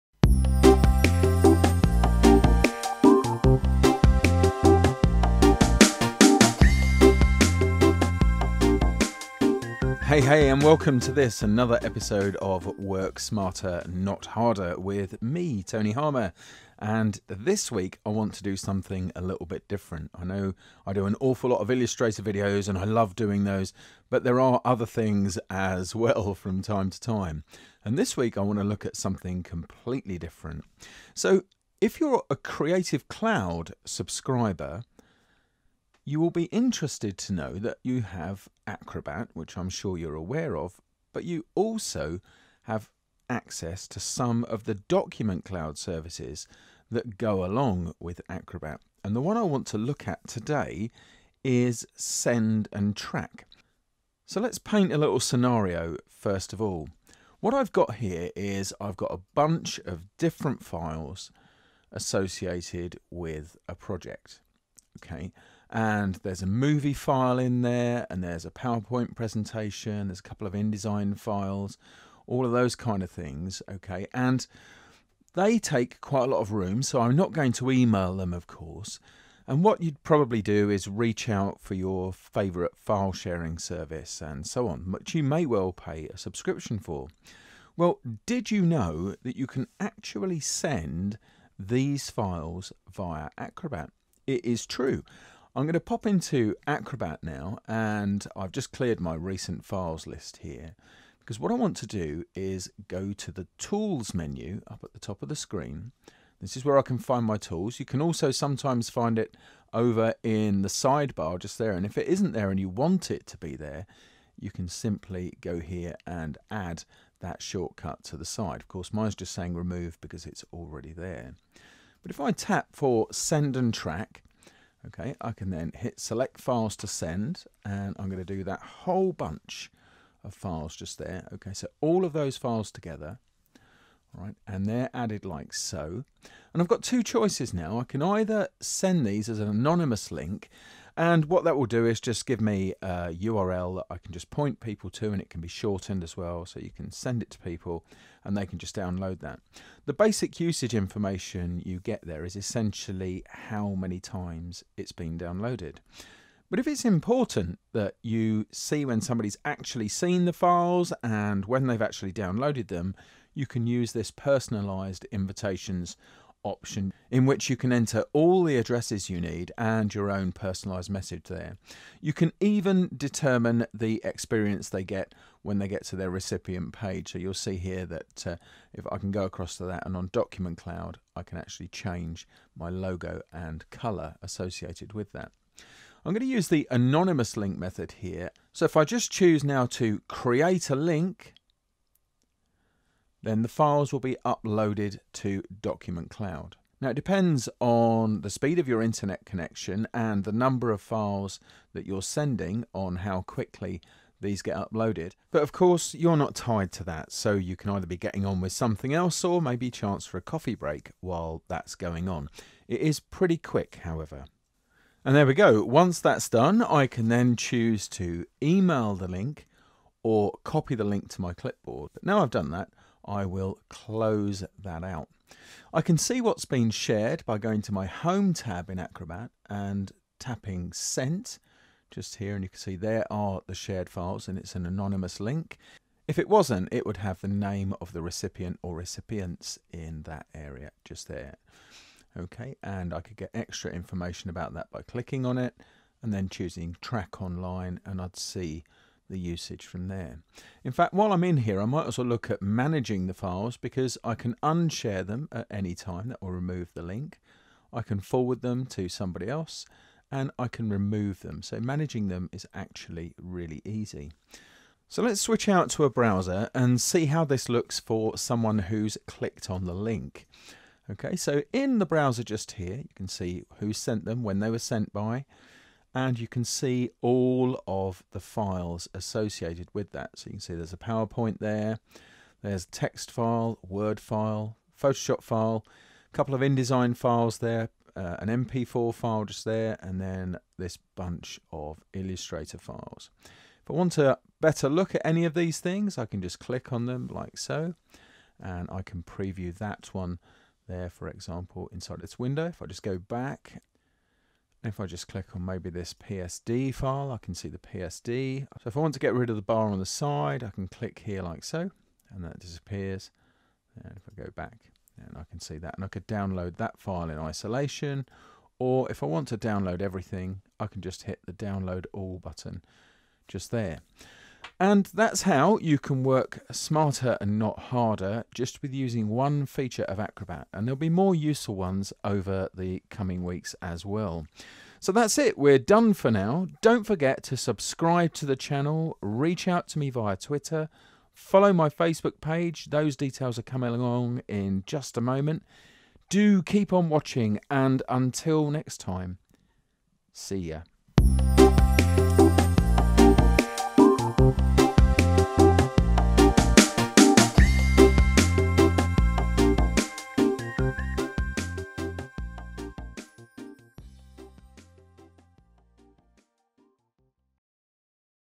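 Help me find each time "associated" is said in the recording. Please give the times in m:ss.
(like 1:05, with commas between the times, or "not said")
1:01, 3:04, 4:38.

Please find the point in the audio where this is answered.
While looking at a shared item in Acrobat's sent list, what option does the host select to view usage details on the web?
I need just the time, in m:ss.
4:06.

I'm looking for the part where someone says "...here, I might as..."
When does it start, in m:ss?
4:11.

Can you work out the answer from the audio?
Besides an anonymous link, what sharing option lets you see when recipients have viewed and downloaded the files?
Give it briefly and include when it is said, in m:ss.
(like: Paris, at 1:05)
Personalized invitations, at 2:44.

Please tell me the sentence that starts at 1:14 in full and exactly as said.
And they take quite a lot of room, so I'm not going to email them, of course.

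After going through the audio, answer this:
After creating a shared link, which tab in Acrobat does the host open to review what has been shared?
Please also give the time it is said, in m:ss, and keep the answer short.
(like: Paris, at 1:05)
Home, at 3:47.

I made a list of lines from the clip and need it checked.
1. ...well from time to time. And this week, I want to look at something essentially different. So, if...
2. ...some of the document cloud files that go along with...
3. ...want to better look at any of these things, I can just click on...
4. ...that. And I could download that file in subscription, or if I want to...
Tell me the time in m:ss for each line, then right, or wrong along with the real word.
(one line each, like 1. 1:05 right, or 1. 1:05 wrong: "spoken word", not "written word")
1. 0:25 wrong: "completely", not "essentially"
2. 0:43 wrong: "services", not "files"
3. 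4:53 right
4. 5:15 wrong: "isolation", not "subscription".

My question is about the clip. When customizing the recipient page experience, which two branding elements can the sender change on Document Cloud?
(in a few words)
Logo and color.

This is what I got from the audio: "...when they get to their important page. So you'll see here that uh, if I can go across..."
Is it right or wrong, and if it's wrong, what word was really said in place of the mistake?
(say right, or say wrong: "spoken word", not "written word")
wrong: "recipient", not "important".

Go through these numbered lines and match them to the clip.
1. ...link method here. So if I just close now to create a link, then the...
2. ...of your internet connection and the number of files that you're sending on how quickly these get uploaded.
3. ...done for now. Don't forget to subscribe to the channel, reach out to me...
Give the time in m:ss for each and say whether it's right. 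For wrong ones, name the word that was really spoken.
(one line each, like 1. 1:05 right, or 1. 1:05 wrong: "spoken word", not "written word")
1. 3:07 wrong: "choose", not "close"
2. 3:18 right
3. 5:35 right.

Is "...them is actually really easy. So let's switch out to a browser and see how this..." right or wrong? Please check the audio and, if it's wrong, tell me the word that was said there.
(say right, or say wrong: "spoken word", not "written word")
right.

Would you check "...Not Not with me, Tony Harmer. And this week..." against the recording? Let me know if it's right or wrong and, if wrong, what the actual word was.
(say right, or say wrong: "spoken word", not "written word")
wrong: "Harder", not "Not".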